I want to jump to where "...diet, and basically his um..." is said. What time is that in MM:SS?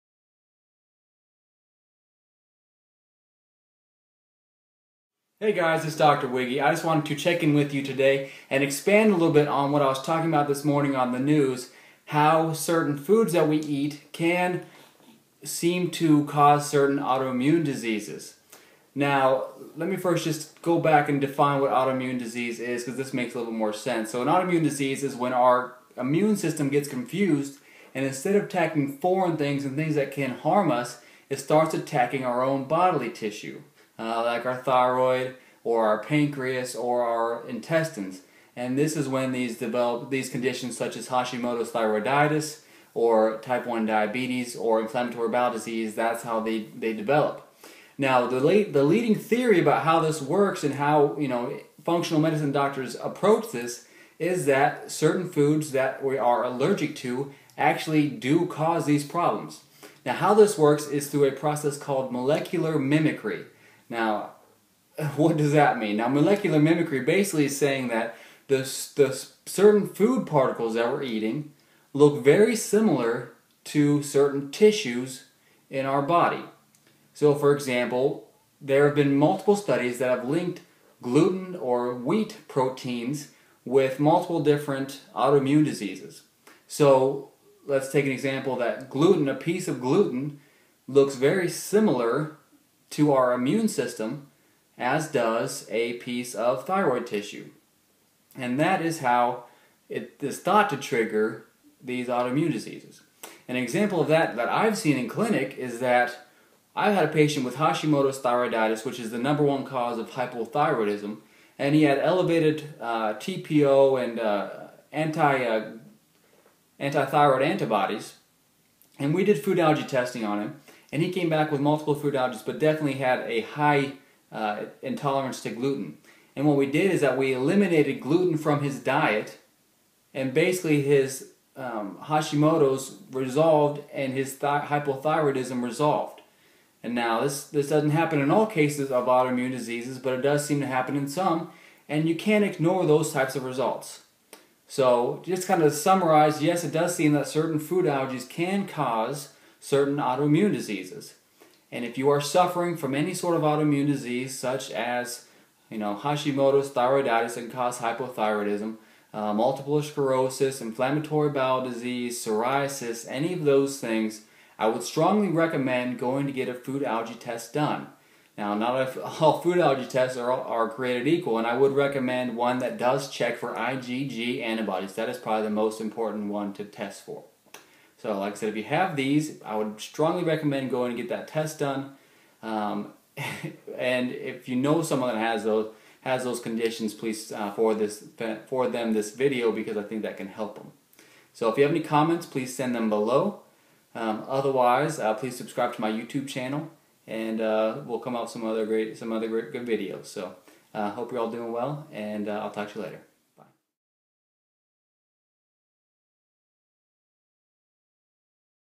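02:08.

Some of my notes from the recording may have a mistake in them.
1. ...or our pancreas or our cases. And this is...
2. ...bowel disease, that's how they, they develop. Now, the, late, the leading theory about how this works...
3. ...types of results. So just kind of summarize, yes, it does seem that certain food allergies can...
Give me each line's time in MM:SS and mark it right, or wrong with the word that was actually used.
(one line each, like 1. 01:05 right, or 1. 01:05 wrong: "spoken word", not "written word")
1. 00:35 wrong: "intestines", not "cases"
2. 00:45 right
3. 02:23 right.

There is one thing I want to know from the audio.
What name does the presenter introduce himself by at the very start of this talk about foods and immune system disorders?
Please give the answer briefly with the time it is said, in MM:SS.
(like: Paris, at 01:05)
Dr. Wiggy, at 00:05.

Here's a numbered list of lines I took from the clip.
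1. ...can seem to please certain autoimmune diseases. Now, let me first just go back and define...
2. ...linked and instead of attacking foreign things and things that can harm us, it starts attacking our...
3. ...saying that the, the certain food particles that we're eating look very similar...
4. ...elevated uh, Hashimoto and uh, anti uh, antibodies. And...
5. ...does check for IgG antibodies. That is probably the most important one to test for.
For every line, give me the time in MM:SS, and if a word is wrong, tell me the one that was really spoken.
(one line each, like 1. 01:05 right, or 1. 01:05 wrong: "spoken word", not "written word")
1. 00:14 wrong: "cause", not "please"
2. 00:26 wrong: "confused", not "linked"
3. 01:07 right
4. 01:51 wrong: "TPO", not "Hashimoto"
5. 02:52 right.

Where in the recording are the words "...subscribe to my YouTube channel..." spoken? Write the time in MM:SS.
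03:15.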